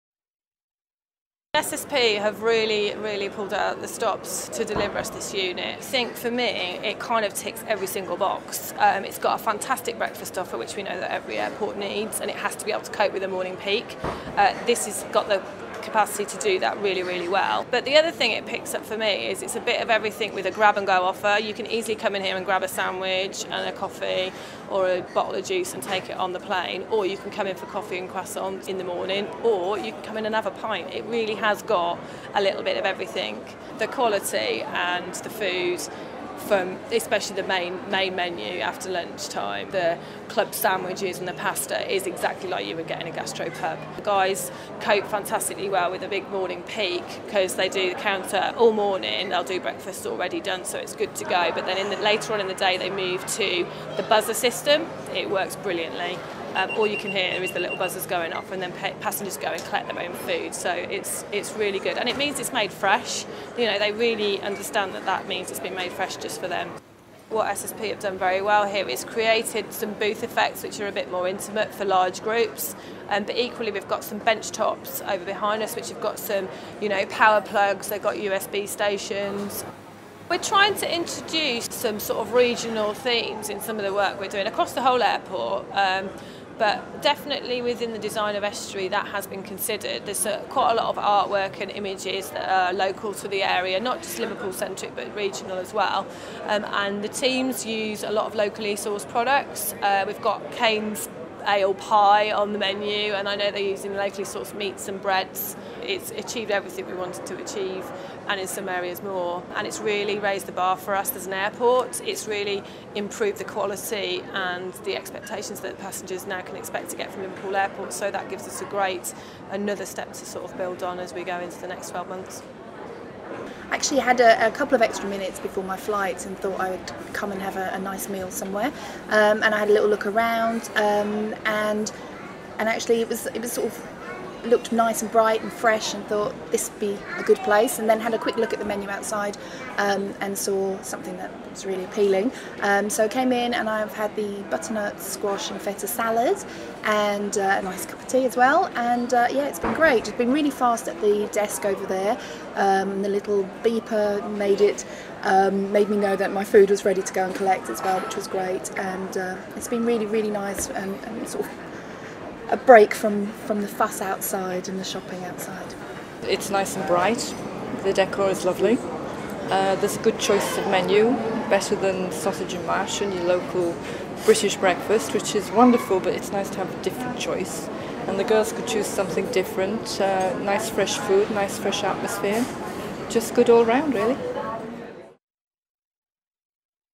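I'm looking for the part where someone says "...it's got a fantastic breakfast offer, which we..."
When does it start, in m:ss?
0:09.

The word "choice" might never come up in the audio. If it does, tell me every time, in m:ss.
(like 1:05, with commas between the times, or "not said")
2:50, 2:57.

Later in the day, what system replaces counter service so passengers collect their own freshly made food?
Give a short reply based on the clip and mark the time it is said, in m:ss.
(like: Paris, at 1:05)
buzzer system, at 0:54.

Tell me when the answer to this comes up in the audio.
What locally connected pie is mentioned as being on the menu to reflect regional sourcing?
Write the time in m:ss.
1:40.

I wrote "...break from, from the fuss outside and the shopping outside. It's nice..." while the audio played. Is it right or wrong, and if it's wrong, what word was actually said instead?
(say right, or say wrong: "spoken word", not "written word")
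right.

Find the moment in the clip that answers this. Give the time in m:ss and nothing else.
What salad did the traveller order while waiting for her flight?
2:24.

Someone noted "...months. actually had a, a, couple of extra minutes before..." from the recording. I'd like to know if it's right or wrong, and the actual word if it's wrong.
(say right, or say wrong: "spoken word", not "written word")
right.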